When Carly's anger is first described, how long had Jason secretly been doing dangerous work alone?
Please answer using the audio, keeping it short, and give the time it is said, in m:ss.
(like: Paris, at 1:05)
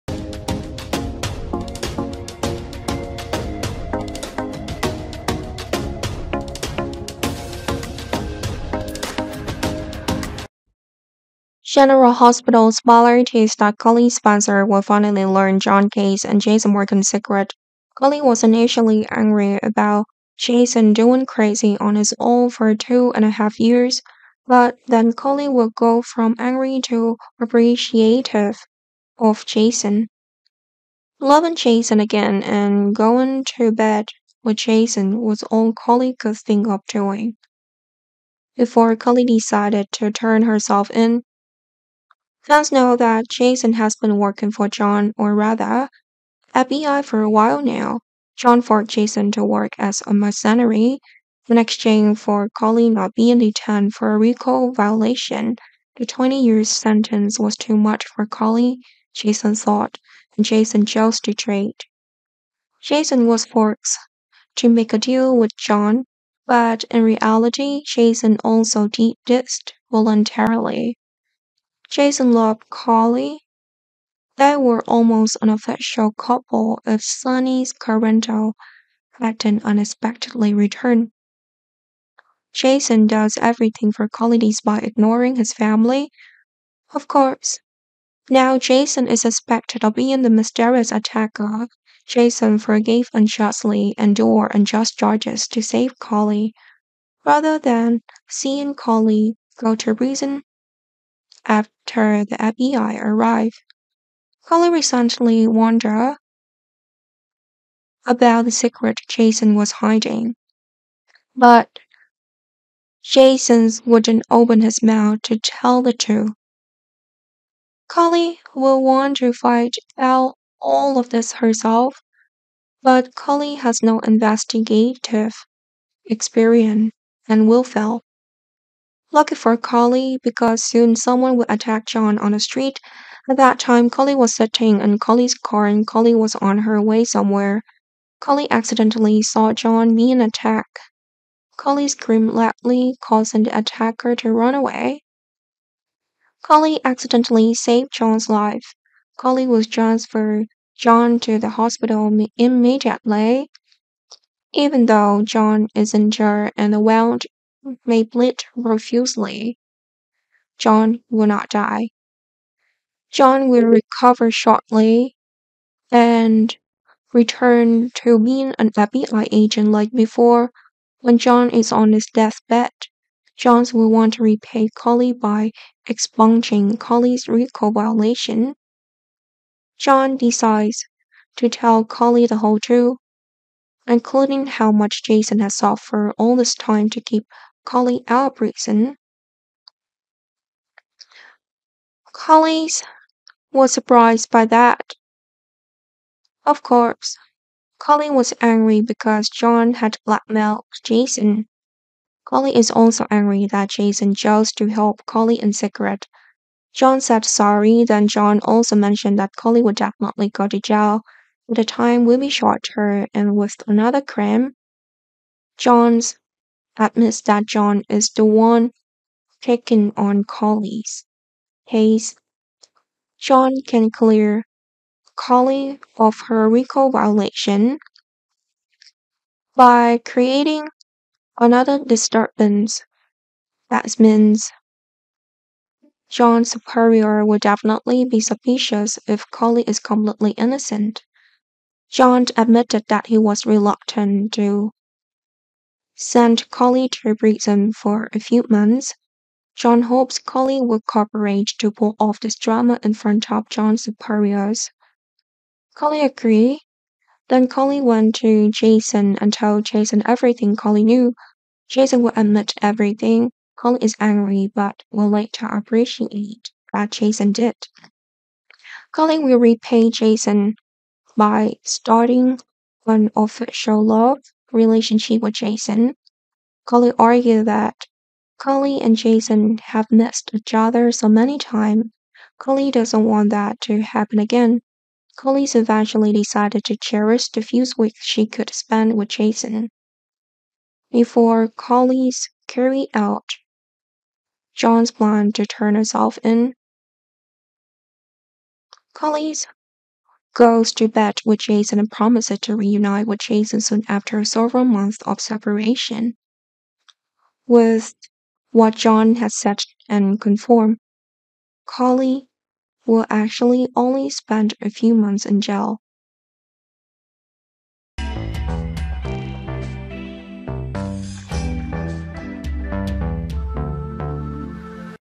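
2 and a half years, at 0:22.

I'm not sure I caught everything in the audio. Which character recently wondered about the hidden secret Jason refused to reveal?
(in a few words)
Holly.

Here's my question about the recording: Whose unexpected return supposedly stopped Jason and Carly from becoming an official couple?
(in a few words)
Sonny Corinthos.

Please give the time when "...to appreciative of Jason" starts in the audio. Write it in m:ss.
0:26.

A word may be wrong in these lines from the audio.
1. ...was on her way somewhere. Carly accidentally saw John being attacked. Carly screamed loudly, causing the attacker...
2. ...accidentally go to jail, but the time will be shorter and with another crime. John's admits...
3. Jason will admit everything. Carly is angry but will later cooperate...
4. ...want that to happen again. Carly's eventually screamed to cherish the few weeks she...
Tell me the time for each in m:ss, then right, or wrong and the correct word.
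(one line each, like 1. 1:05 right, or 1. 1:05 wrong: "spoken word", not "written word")
1. 2:16 right
2. 3:29 wrong: "definitely", not "accidentally"
3. 4:21 wrong: "appreciate", not "cooperate"
4. 4:43 wrong: "decided", not "screamed".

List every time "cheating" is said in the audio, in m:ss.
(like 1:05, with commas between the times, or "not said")
not said.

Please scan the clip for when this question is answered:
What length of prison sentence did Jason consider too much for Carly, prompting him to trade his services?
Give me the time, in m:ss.
0:56.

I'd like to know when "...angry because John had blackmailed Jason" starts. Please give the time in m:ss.
3:18.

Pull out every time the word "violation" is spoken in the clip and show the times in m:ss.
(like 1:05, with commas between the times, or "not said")
0:54, 2:57, 3:46.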